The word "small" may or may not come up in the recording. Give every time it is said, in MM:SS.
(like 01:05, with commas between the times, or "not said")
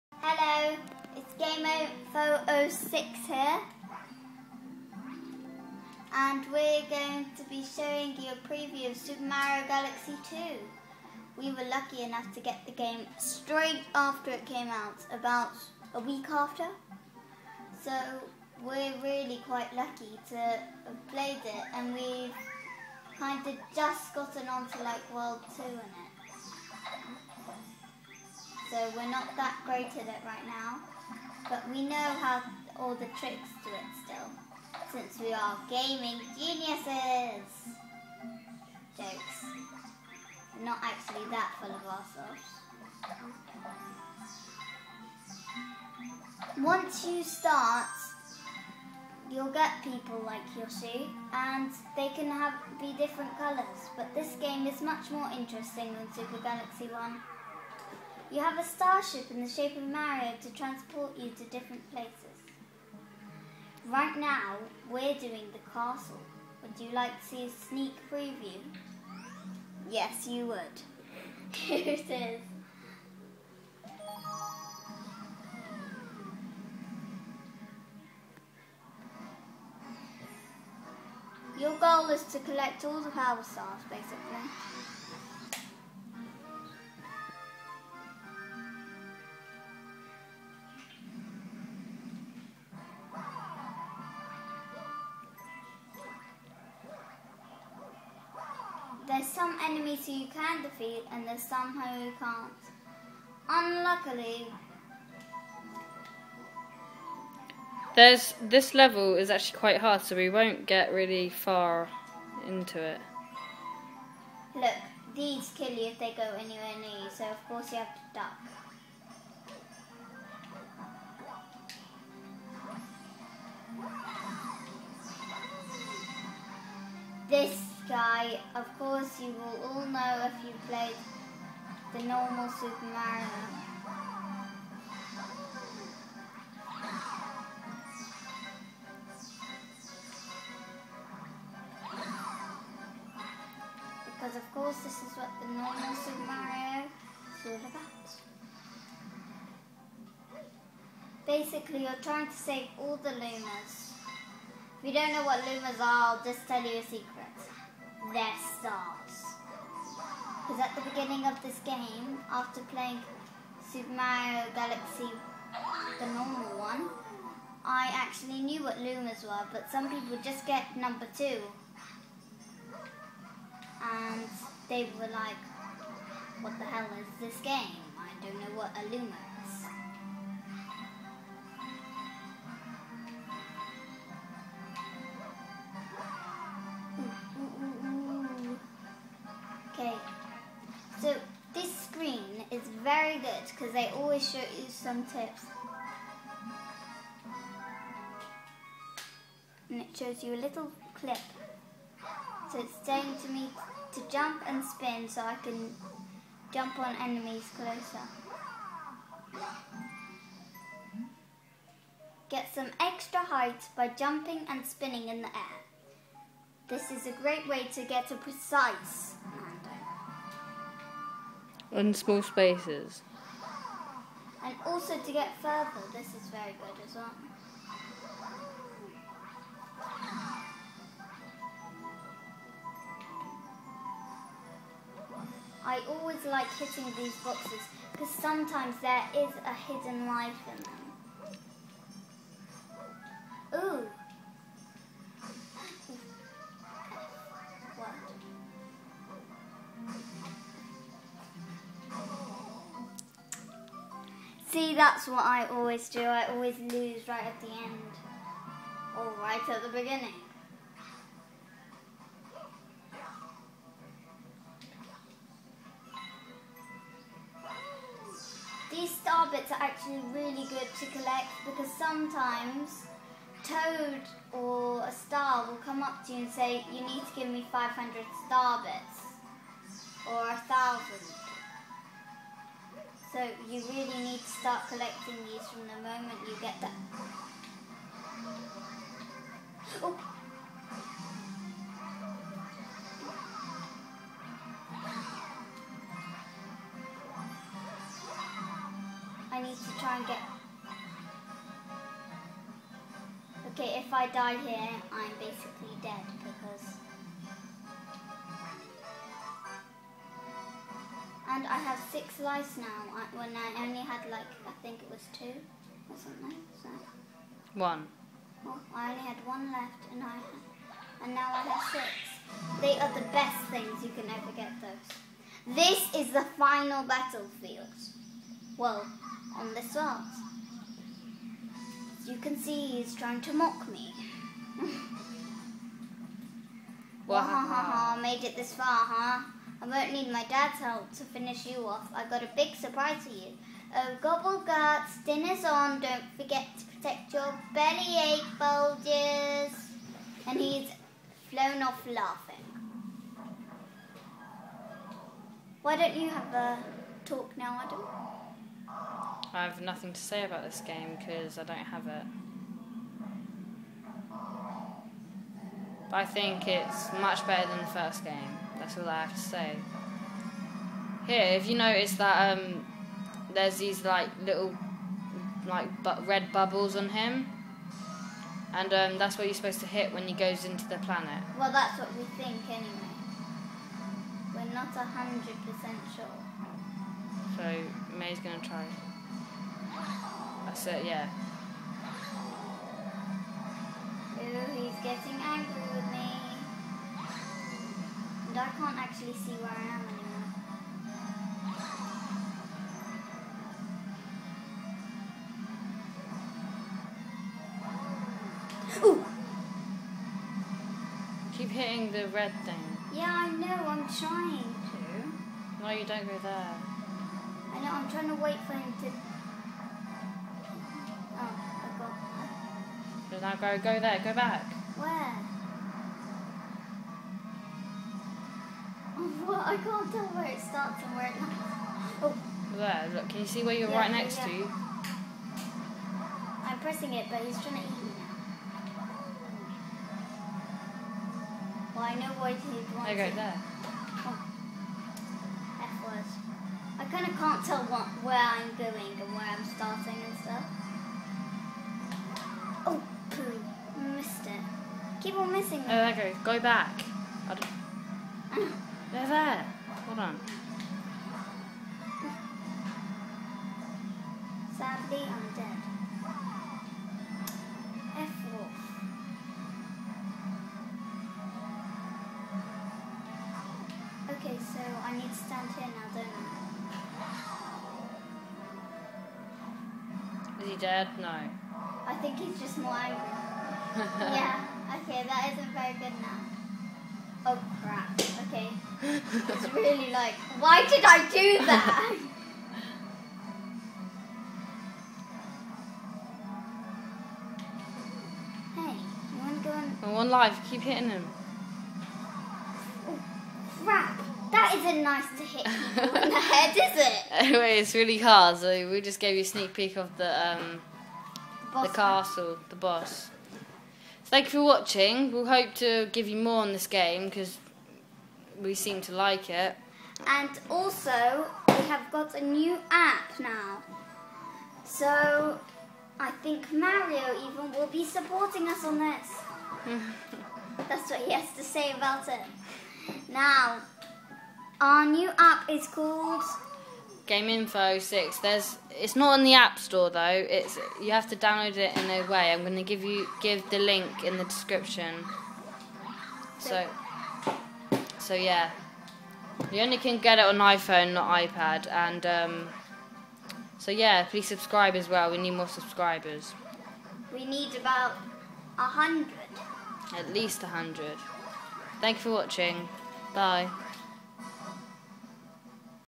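03:41.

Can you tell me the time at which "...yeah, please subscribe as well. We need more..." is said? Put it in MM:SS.
09:13.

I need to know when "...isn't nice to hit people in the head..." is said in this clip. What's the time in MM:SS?
08:24.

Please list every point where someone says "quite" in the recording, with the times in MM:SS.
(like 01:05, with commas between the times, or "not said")
00:19, 01:49.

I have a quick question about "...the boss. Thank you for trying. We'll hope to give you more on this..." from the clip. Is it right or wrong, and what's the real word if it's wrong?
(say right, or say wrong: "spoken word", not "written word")
wrong: "watching", not "trying".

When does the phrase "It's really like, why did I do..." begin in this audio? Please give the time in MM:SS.
08:08.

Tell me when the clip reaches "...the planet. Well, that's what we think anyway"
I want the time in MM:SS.
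06:20.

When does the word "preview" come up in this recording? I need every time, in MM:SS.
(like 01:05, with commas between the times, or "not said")
00:08, 01:08.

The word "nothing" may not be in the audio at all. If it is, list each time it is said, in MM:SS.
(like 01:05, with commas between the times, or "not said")
05:59.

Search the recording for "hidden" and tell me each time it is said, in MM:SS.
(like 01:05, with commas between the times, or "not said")
03:59.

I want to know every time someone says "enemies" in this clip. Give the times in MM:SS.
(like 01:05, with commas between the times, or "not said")
01:39, 03:27.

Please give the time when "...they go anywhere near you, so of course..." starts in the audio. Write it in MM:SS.
01:55.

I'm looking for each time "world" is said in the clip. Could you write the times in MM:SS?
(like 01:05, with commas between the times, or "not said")
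00:25, 05:29.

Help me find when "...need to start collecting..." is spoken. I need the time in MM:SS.
04:44.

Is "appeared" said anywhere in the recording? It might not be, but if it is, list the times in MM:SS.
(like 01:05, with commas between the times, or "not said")
not said.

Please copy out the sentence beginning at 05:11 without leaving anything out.
And I have six lives now when I only had like, I think it was two or something.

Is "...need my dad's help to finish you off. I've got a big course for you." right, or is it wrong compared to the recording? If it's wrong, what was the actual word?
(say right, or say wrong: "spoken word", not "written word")
wrong: "surprise", not "course".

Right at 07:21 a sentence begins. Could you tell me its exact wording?
Well, I know why he'd want There, go, there.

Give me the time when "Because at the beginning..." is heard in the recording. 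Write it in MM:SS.
02:40.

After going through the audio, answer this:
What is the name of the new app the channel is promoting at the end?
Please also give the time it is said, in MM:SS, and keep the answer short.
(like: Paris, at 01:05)
Game Info Six, at 08:57.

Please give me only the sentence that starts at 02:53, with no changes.
And they were like, what the hell is this game?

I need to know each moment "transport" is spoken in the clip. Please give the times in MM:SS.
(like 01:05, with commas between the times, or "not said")
01:00.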